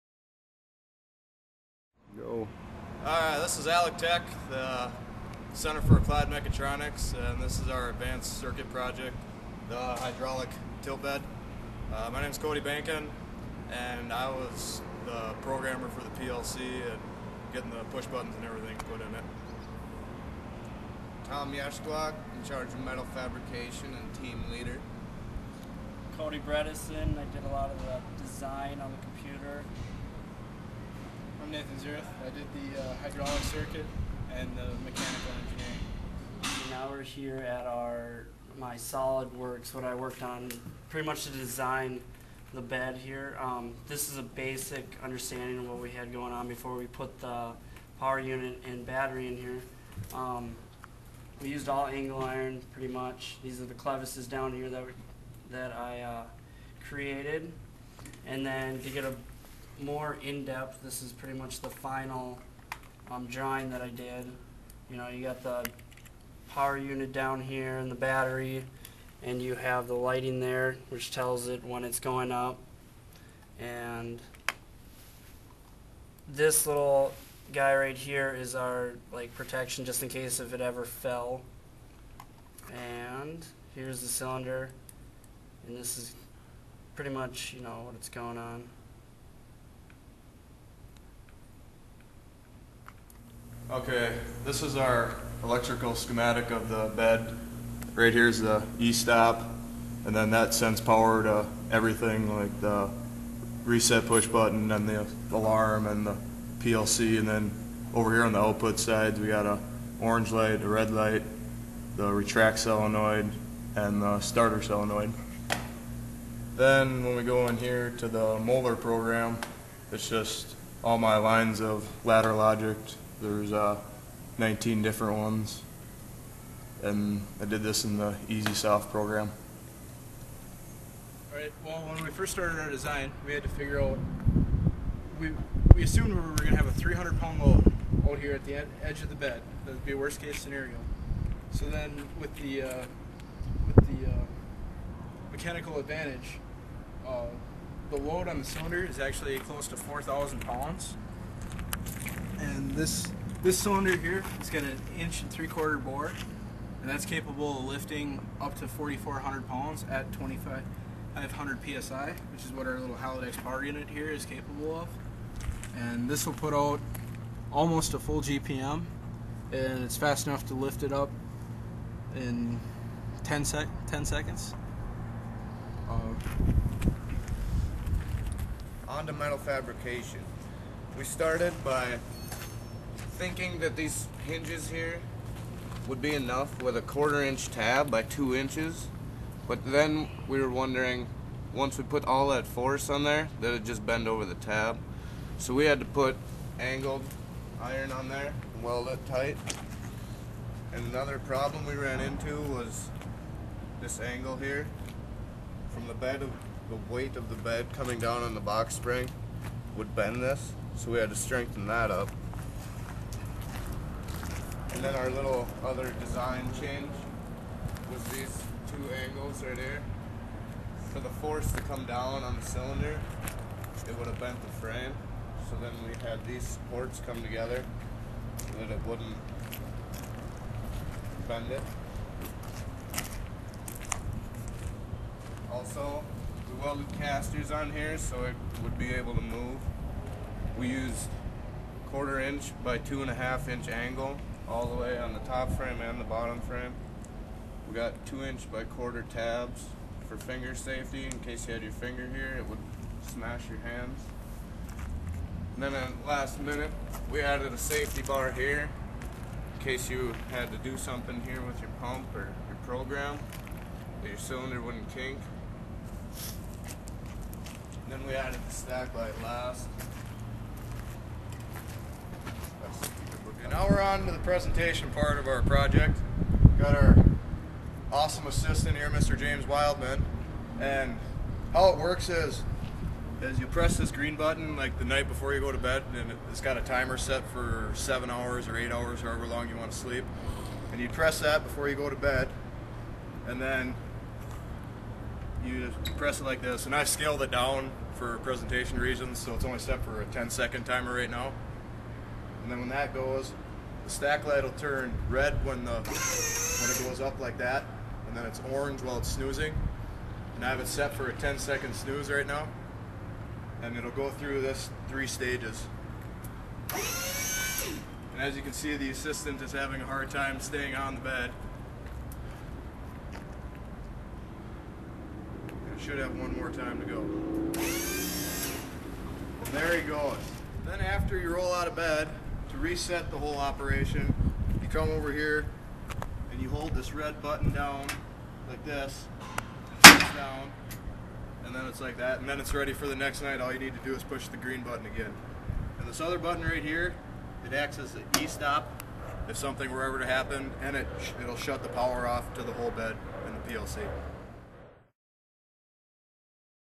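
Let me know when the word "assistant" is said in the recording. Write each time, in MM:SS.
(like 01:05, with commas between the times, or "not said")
04:38, 05:18.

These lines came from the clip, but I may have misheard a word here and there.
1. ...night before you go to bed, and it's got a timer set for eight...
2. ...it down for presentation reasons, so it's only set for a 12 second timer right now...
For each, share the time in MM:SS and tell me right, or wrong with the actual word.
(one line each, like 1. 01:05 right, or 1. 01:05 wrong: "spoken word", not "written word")
1. 04:44 wrong: "seven", not "eight"
2. 04:57 wrong: "10", not "12".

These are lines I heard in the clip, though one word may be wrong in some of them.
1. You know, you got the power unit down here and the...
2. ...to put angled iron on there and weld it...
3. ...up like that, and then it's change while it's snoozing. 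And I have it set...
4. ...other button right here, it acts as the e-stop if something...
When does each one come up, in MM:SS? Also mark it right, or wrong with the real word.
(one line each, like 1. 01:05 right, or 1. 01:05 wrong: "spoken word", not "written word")
1. 01:04 right
2. 03:15 right
3. 05:07 wrong: "orange", not "change"
4. 05:46 right.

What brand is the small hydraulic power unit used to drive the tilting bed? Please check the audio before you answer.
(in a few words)
Haldex.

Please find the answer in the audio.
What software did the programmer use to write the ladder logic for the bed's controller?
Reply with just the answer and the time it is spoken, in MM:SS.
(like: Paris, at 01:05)
Easy Soft, at 02:08.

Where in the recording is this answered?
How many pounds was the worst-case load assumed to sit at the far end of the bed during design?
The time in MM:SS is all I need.
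02:16.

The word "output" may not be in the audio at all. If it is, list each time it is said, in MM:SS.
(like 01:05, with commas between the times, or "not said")
01:48.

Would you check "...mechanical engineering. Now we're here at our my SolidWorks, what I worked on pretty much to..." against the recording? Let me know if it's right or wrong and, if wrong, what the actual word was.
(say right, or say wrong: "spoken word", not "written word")
right.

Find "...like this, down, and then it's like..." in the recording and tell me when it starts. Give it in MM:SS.
05:38.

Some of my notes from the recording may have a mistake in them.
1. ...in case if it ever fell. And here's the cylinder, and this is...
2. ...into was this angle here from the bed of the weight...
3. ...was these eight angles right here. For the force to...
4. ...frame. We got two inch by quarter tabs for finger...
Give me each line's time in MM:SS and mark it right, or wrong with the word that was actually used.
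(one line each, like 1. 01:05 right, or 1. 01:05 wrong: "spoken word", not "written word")
1. 01:20 right
2. 03:21 right
3. 03:37 wrong: "two", not "eight"
4. 04:06 right.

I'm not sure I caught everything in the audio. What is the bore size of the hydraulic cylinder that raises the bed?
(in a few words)
1 3/4 inch.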